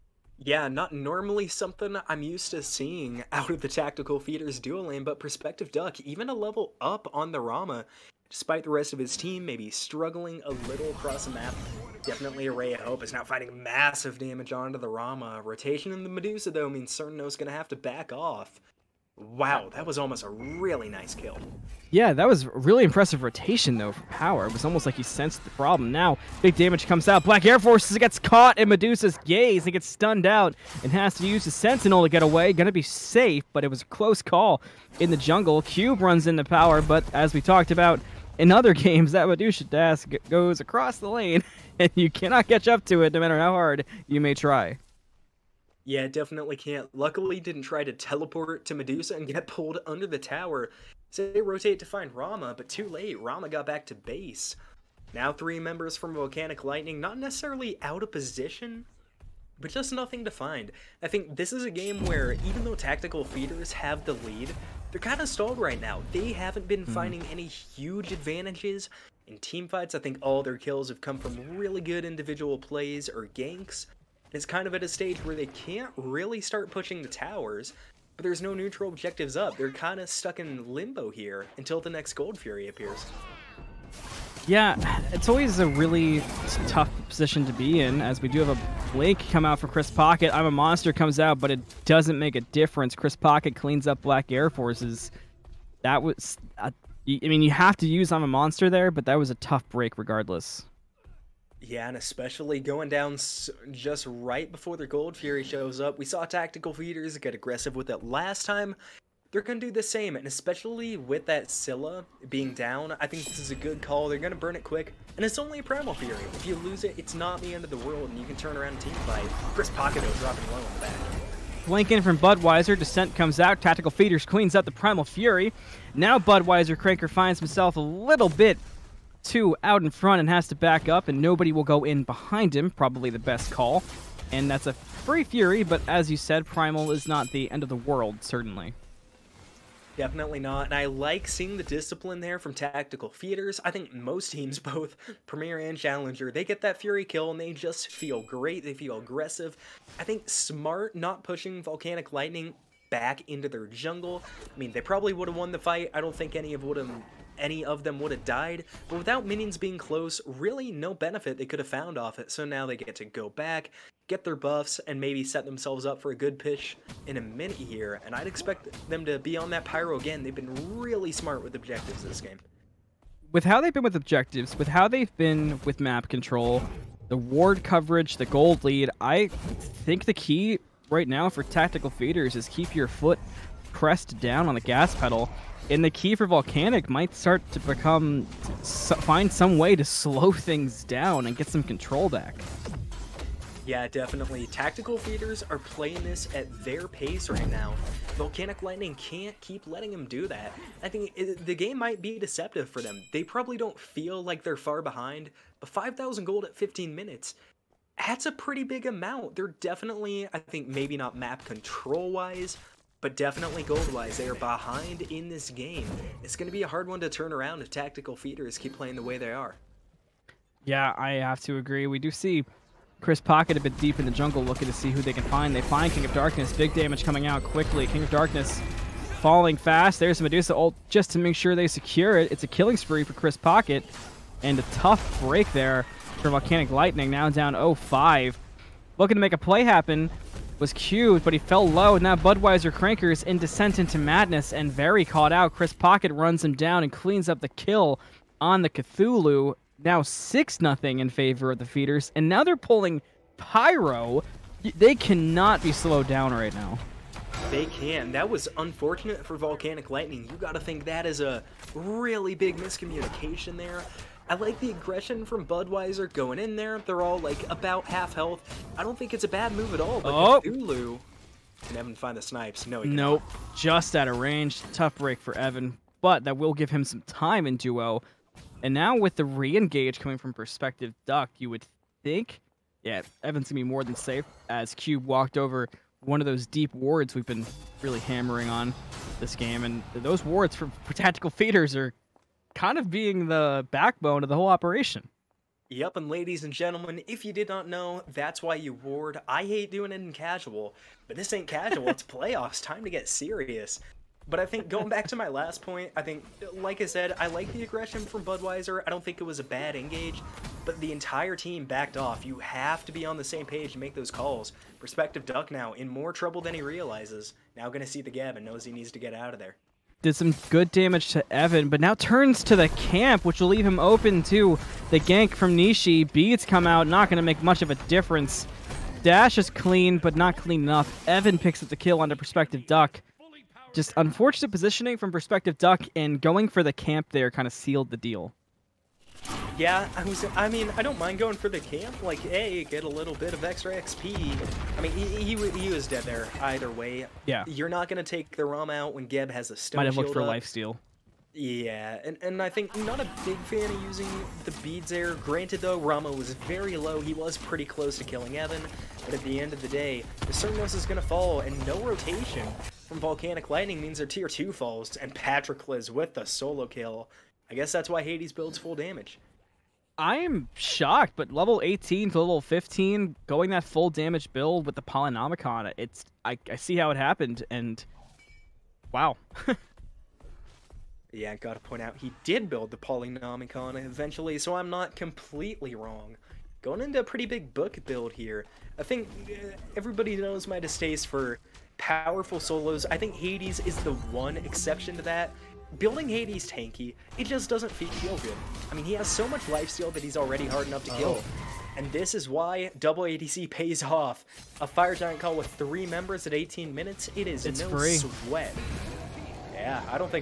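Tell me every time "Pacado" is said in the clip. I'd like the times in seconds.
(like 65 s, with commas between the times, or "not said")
119 s.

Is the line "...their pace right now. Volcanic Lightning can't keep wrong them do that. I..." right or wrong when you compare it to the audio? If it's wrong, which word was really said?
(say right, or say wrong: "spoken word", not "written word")
wrong: "letting", not "wrong".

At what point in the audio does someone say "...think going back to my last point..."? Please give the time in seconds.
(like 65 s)
304 s.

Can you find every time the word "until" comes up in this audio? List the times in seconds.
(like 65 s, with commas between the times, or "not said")
81 s.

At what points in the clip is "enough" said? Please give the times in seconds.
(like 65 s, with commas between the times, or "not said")
330 s, 400 s.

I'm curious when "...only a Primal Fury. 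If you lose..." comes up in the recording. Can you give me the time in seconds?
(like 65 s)
115 s.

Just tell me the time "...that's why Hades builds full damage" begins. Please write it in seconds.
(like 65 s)
367 s.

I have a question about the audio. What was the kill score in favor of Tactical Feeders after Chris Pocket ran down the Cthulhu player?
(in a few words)
6-0.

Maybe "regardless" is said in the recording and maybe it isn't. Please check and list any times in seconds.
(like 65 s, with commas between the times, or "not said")
99 s.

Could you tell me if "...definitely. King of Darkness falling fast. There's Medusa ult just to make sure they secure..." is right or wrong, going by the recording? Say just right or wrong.
wrong.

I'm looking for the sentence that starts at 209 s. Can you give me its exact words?
They're definitely, I think, maybe not map control wise, but definitely gold-wise, they are behind in this game.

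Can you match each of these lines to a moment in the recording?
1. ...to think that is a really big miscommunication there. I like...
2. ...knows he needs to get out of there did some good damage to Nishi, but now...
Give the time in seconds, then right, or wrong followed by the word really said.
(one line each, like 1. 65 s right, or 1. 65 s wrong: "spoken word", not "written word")
1. 260 s right
2. 318 s wrong: "Evan", not "Nishi".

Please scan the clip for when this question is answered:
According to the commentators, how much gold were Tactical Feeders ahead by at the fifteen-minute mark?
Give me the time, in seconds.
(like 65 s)
205 s.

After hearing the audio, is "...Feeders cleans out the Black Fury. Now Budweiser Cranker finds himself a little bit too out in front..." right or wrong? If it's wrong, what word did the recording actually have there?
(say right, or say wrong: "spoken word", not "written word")
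wrong: "Primal", not "Black".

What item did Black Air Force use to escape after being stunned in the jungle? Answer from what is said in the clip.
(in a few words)
Sentinel.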